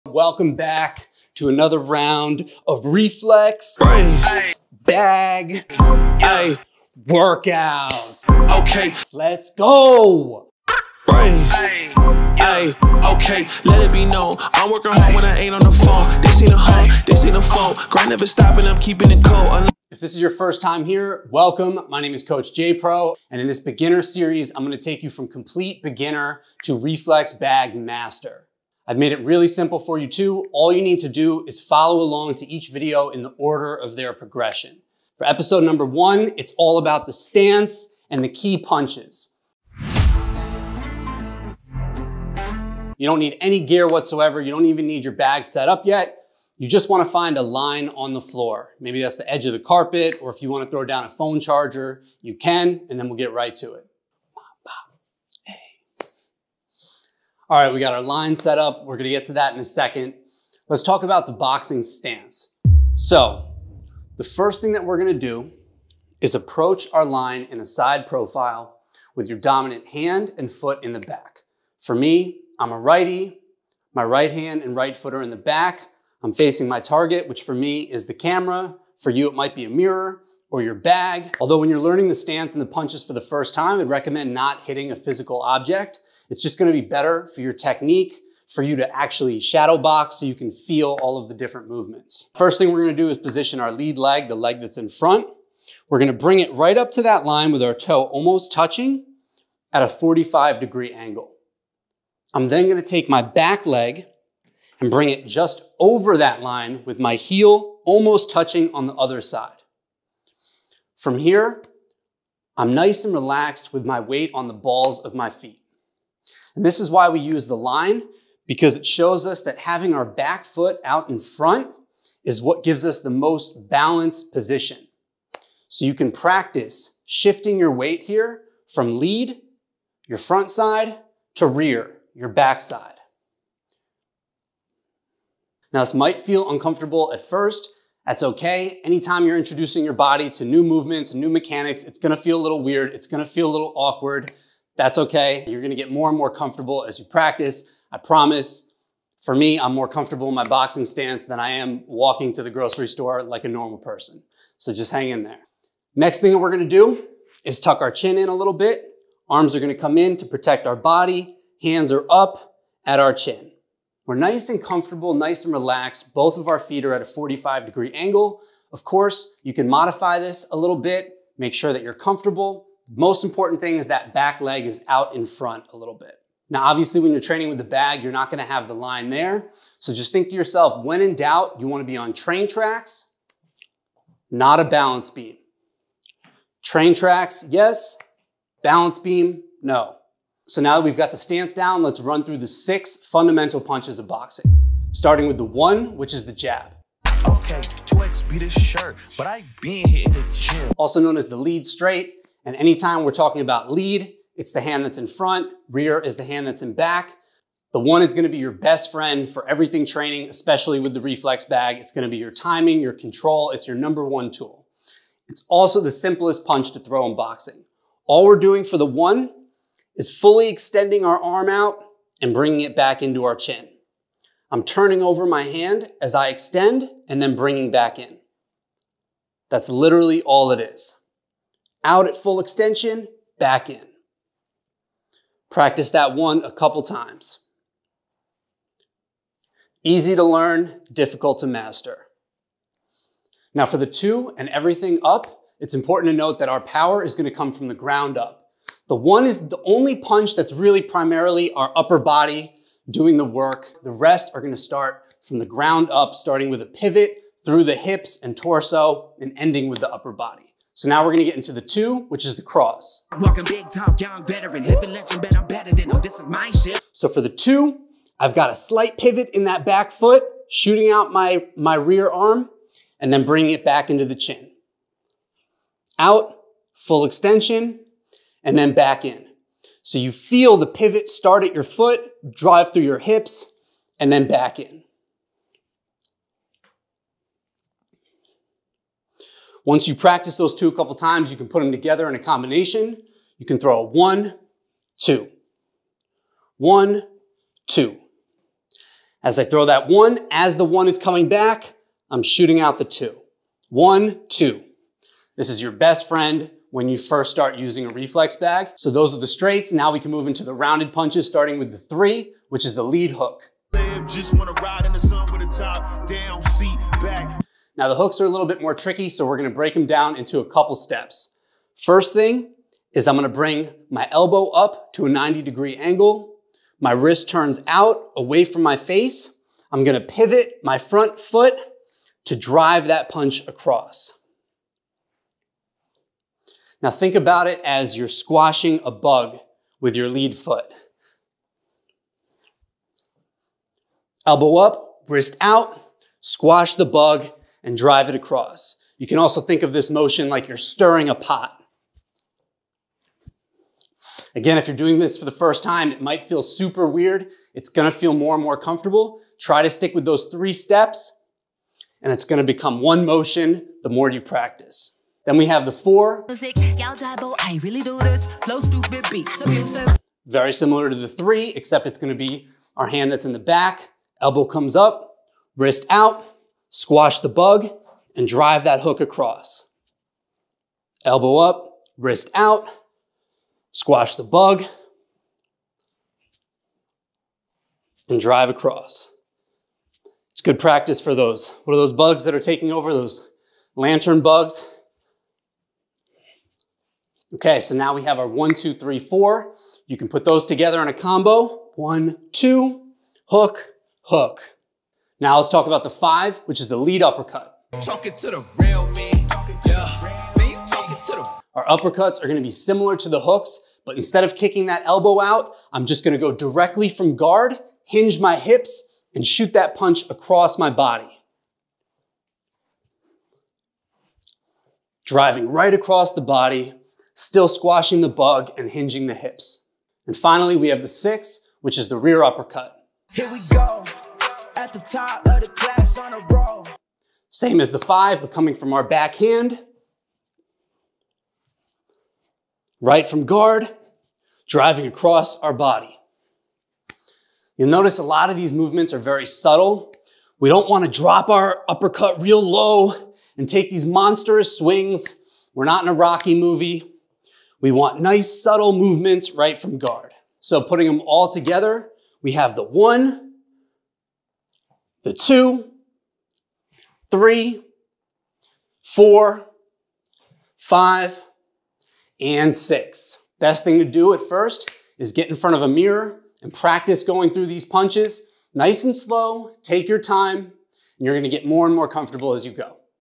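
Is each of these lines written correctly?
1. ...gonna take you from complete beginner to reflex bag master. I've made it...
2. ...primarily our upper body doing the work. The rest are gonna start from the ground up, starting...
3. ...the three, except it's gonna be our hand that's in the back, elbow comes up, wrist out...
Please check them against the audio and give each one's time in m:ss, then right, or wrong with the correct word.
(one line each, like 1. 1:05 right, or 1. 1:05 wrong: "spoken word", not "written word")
1. 0:24 right
2. 4:10 right
3. 6:10 right.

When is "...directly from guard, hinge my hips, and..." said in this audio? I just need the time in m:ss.
6:56.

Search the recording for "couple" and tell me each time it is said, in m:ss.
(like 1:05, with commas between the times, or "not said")
3:56, 4:50, 5:20.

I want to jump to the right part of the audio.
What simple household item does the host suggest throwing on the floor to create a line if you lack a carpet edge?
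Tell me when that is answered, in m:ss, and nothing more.
0:51.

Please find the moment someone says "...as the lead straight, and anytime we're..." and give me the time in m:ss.
3:21.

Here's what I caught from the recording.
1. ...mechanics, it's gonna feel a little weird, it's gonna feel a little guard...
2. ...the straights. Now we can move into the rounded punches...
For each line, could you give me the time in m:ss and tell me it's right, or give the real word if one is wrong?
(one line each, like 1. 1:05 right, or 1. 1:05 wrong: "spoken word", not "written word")
1. 2:21 wrong: "awkward", not "guard"
2. 5:09 right.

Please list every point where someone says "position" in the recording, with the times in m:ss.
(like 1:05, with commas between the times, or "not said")
1:33, 2:04.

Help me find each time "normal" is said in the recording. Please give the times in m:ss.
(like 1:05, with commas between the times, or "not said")
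2:33.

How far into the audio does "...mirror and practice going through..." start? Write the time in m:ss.
7:55.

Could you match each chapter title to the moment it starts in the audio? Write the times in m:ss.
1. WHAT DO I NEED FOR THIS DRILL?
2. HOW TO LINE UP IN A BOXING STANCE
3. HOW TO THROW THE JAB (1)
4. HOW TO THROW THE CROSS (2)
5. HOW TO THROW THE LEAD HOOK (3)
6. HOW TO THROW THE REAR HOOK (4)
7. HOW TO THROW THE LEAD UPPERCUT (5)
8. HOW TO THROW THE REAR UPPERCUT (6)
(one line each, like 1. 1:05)
1. 0:43
2. 1:07
3. 3:10
4. 4:20
5. 5:09
6. 6:05
7. 6:45
8. 7:10.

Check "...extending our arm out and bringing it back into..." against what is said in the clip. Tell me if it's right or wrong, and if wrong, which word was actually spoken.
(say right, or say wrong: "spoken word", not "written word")
right.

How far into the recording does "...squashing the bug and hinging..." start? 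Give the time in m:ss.
7:07.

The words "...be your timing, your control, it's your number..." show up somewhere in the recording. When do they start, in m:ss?
3:32.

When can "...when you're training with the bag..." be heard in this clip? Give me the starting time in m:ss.
2:56.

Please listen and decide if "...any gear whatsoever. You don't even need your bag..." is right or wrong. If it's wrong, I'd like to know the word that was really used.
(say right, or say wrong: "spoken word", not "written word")
right.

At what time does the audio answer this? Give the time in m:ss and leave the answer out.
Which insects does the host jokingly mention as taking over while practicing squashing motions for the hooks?
6:33.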